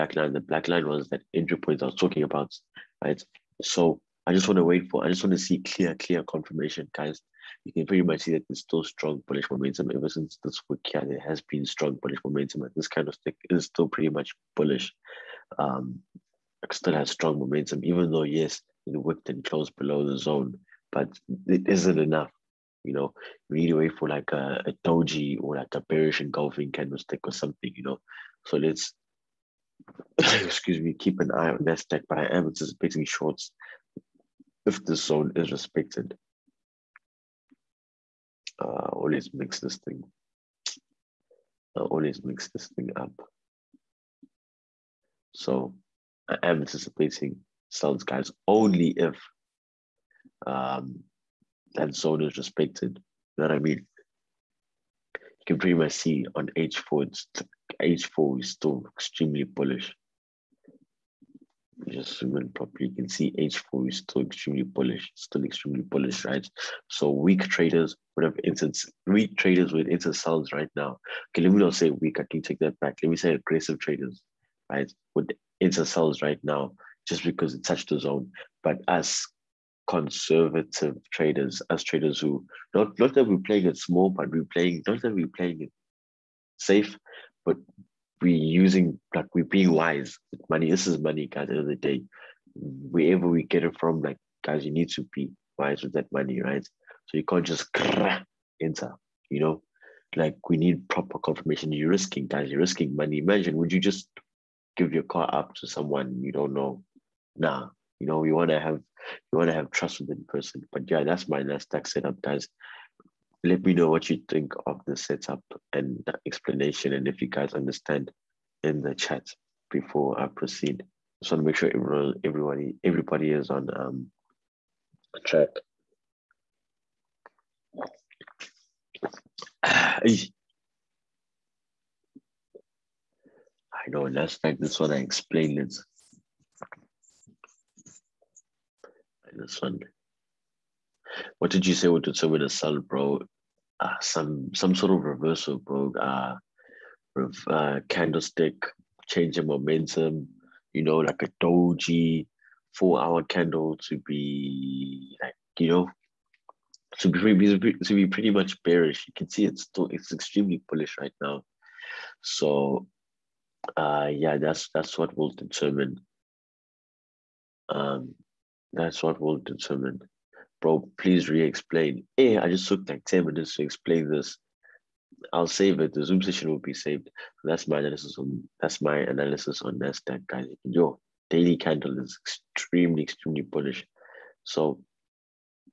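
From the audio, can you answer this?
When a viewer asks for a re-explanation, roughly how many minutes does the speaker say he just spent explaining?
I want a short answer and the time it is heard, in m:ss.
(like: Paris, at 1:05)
10, at 2:53.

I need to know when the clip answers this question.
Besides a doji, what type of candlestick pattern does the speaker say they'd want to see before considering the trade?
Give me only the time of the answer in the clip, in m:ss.
0:25.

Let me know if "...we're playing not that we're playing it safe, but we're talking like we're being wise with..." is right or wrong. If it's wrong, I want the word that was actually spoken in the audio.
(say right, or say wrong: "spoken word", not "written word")
wrong: "using", not "talking".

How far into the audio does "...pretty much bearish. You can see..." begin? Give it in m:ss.
2:38.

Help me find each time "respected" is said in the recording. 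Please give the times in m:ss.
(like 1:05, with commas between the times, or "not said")
0:35, 0:52.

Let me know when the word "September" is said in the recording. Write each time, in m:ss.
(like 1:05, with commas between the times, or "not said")
not said.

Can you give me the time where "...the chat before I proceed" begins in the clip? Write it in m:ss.
1:58.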